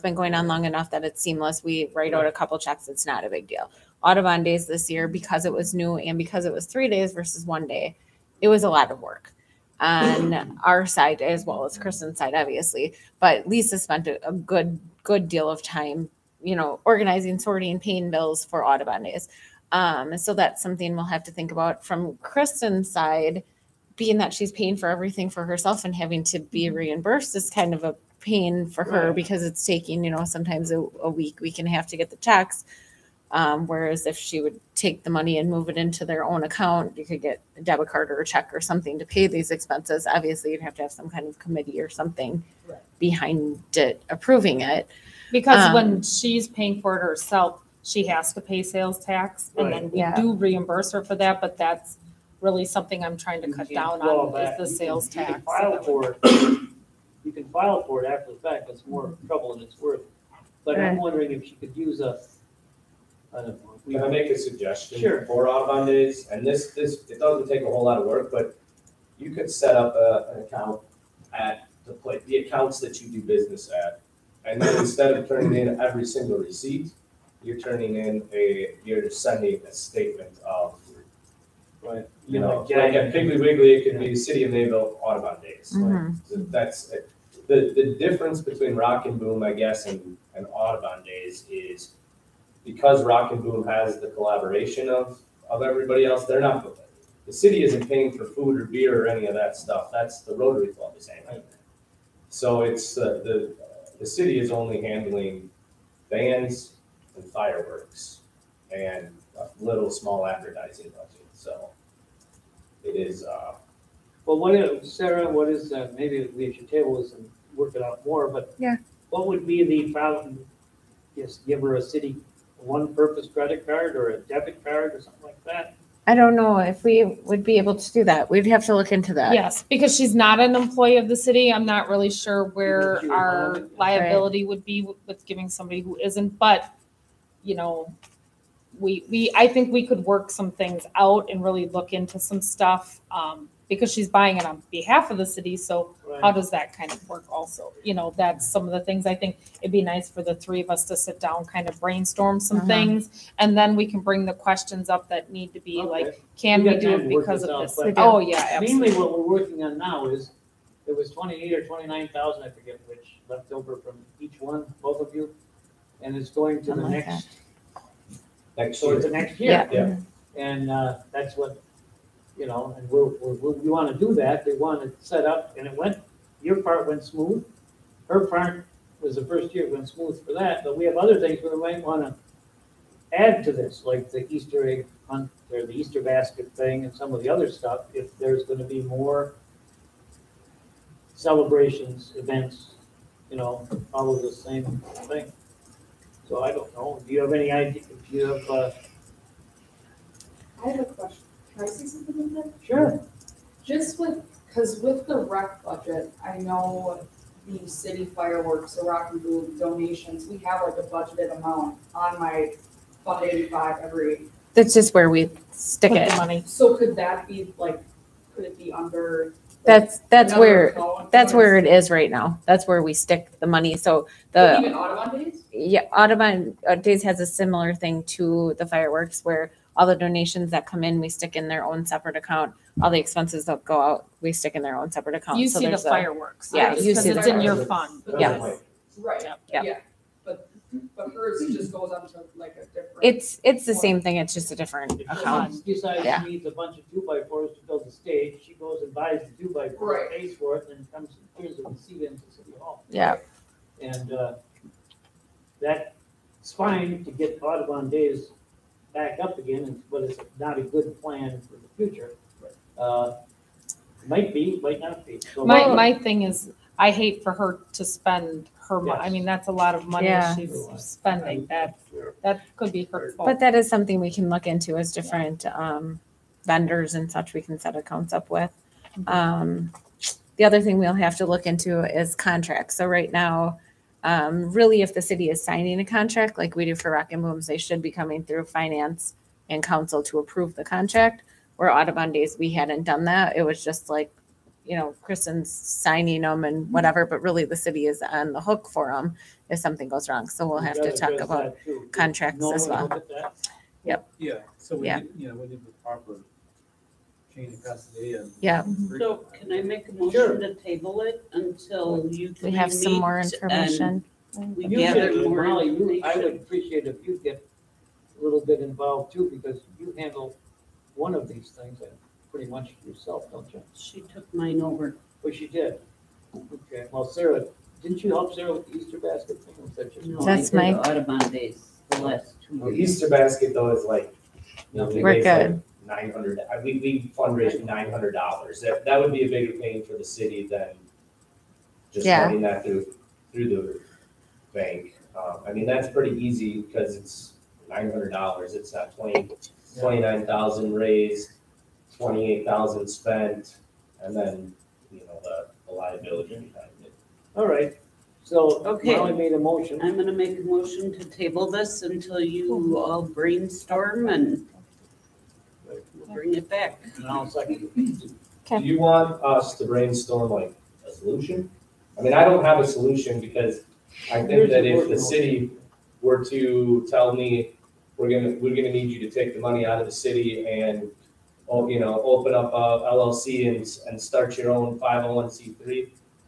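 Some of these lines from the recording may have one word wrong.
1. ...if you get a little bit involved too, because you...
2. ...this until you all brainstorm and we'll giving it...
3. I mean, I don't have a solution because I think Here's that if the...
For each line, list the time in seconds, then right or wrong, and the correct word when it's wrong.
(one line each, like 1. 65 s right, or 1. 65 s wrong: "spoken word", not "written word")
1. 316 s right
2. 361 s wrong: "bring", not "giving"
3. 371 s right.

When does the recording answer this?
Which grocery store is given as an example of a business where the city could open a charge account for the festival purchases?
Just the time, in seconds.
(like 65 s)
83 s.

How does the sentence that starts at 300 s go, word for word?
So we'll have to talk about contracts as well.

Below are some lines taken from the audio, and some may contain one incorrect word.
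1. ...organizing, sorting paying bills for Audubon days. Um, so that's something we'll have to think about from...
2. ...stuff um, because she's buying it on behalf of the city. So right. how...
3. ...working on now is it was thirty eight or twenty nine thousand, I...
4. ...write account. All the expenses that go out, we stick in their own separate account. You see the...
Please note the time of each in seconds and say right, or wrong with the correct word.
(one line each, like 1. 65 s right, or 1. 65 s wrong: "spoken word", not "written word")
1. 16 s right
2. 142 s right
3. 159 s wrong: "twenty", not "thirty"
4. 231 s wrong: "separate", not "write".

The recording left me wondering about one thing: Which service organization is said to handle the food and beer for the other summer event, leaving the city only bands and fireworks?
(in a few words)
Rotary Club.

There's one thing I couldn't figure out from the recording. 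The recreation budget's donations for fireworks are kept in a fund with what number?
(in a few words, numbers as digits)
85.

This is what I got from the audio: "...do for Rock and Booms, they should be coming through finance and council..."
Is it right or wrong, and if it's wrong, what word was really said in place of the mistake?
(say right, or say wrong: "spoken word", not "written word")
right.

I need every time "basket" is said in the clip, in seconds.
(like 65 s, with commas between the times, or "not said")
186 s, 328 s, 333 s.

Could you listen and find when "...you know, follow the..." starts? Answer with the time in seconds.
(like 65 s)
193 s.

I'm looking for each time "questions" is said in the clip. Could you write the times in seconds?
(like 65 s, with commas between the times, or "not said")
154 s, 200 s.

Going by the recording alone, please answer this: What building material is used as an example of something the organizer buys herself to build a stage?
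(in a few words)
two by fours.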